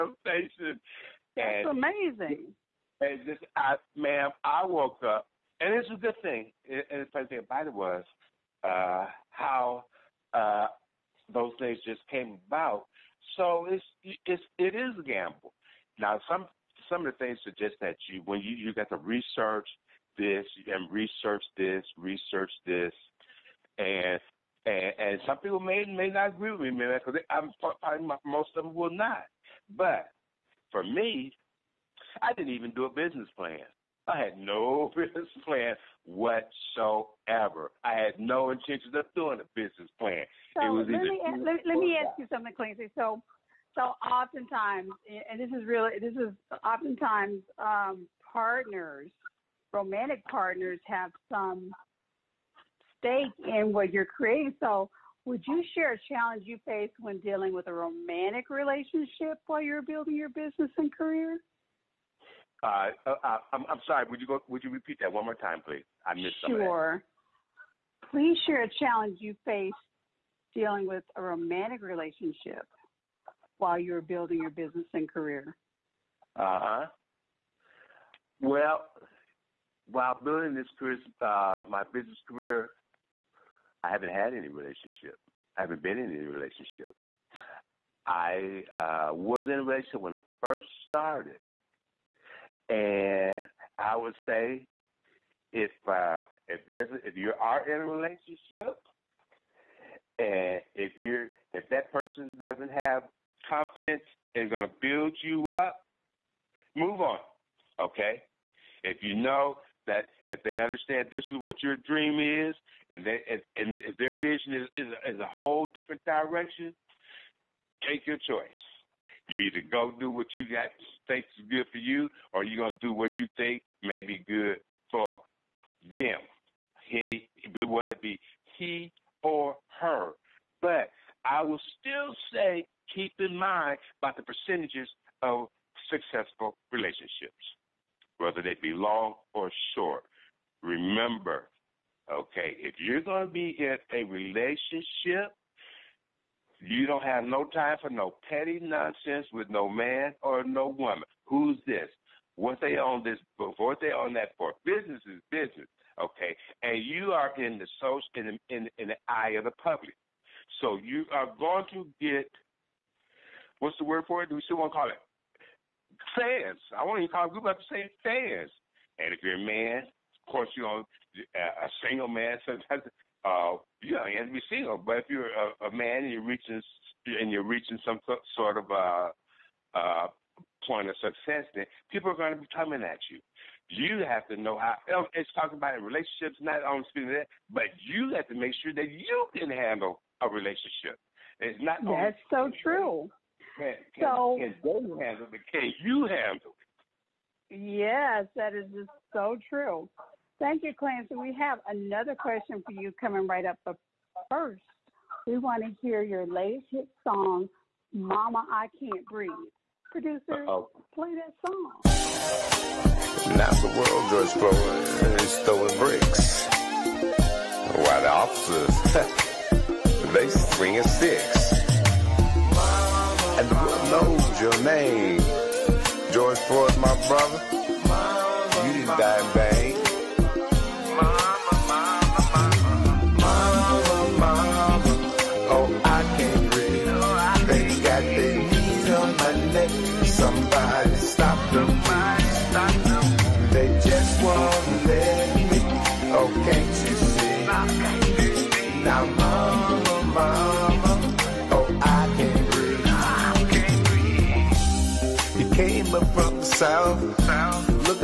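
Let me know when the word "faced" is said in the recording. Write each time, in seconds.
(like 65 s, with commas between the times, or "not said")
56 s, 69 s.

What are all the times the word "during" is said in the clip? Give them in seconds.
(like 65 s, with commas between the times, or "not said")
not said.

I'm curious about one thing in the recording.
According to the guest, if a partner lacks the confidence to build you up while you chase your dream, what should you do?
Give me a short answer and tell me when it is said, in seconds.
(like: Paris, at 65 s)
Move on, at 106 s.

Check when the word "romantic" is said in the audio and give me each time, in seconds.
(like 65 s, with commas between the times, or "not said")
49 s, 57 s, 71 s.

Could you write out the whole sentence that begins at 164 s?
Do we still want to call it fans?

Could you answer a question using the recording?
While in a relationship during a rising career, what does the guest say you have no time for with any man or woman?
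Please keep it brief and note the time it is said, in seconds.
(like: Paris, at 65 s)
Petty nonsense, at 148 s.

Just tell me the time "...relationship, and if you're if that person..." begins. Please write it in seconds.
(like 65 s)
97 s.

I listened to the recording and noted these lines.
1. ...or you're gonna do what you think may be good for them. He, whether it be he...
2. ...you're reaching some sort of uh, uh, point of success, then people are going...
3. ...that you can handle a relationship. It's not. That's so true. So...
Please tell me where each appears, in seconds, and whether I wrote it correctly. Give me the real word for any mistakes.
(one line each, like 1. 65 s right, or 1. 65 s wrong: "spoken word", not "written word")
1. 122 s right
2. 177 s right
3. 188 s right.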